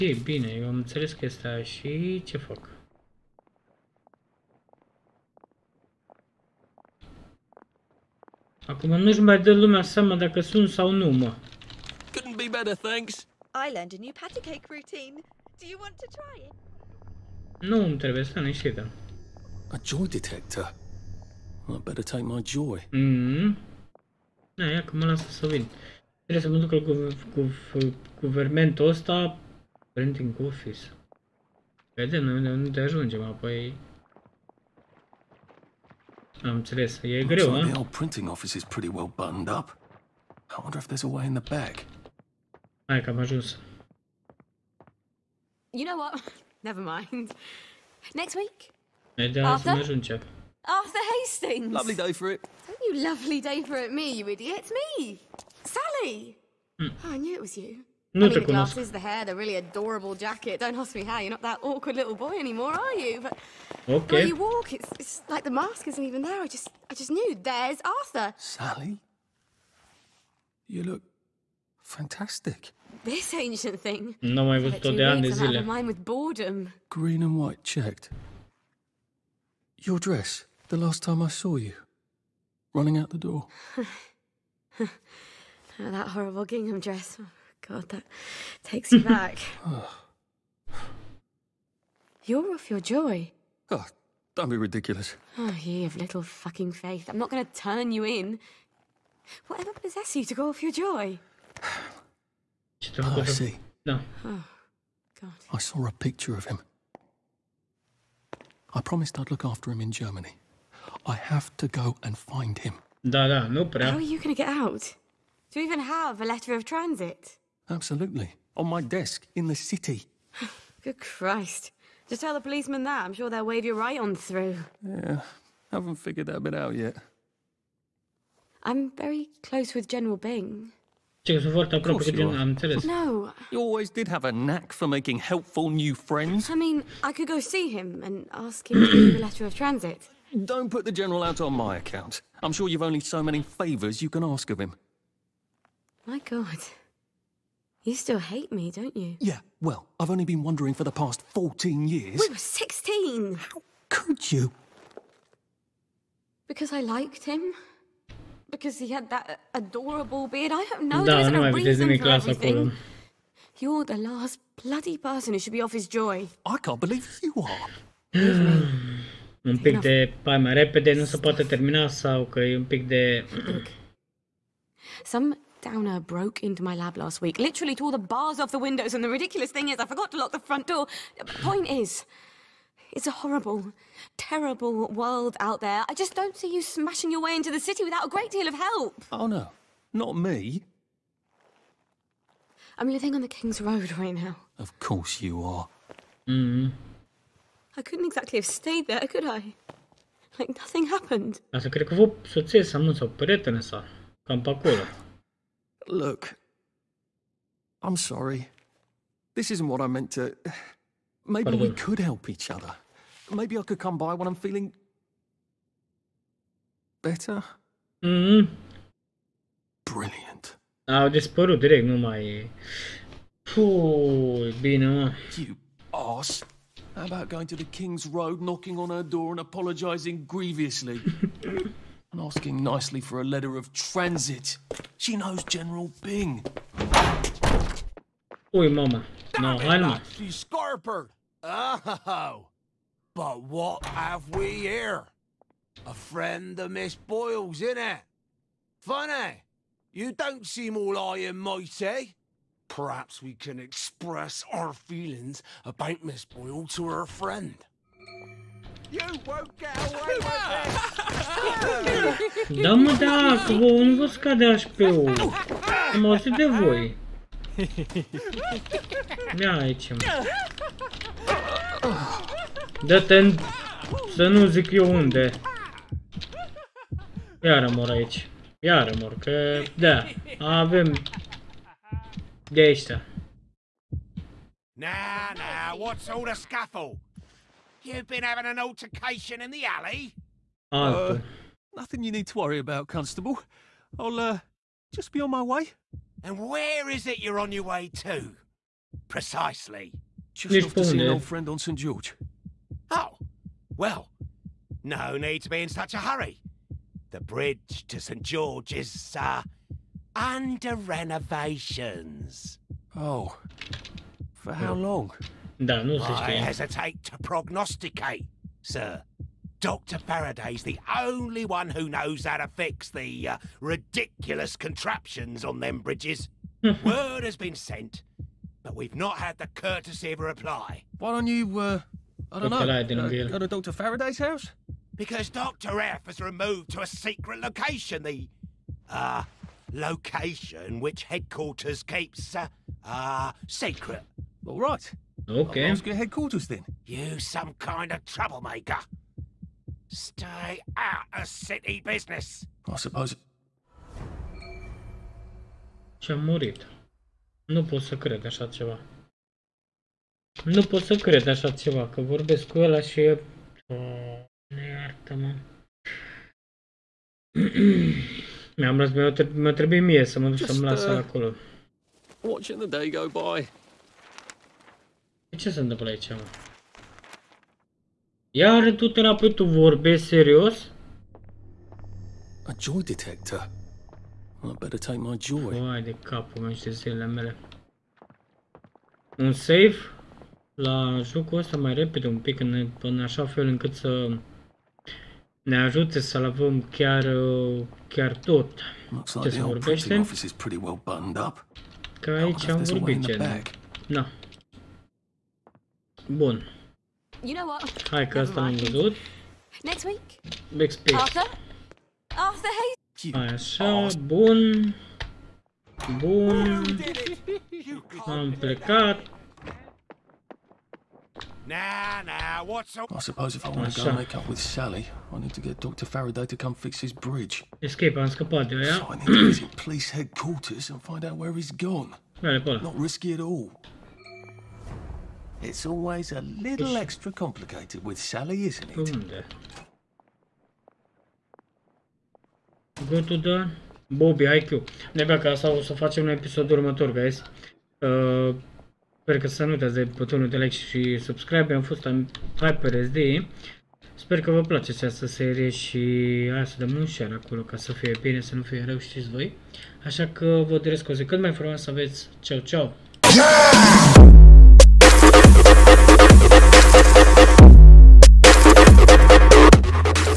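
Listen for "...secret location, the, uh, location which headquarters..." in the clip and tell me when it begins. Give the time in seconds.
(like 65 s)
336 s.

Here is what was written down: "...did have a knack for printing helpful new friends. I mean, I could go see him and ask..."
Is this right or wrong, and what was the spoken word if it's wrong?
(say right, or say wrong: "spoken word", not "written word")
wrong: "making", not "printing".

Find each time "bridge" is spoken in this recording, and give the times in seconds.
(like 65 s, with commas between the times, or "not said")
307 s, 325 s, 426 s.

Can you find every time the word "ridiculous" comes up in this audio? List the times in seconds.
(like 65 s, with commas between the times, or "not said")
94 s, 179 s, 323 s.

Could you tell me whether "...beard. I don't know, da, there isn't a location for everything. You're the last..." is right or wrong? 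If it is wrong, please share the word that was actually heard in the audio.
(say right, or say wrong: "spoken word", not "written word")
wrong: "reason", not "location".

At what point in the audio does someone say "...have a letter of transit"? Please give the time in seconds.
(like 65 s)
115 s.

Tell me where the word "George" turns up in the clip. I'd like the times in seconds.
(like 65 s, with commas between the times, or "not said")
301 s, 308 s.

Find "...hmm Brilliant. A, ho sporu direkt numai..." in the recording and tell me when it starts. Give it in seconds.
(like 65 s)
218 s.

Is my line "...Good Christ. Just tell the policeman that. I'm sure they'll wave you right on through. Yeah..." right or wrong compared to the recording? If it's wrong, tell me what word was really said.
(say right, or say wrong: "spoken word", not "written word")
right.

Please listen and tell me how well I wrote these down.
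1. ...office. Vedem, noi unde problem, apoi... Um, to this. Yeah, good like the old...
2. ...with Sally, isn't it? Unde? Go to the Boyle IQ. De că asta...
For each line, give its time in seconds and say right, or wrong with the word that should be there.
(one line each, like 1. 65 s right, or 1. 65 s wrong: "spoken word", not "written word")
1. 30 s wrong: "ajungem", not "problem"
2. 437 s wrong: "Bobby", not "Boyle".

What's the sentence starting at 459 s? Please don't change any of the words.
Așa că vă doresc o zi cât mai frumoasă aveți.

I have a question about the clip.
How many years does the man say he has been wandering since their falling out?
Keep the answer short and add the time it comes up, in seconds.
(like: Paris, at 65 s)
14, at 151 s.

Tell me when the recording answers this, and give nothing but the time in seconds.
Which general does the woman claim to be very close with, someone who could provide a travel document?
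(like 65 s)
129 s.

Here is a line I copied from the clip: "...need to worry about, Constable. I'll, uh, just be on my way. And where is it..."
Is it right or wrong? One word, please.
right.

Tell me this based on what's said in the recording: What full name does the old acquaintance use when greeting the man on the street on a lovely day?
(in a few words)
Arthur Hastings.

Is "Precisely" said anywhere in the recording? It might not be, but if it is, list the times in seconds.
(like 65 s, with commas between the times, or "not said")
299 s.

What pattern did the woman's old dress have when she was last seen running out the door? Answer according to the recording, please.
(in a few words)
Green and white checked.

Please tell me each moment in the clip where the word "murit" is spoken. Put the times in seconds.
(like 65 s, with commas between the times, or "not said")
356 s.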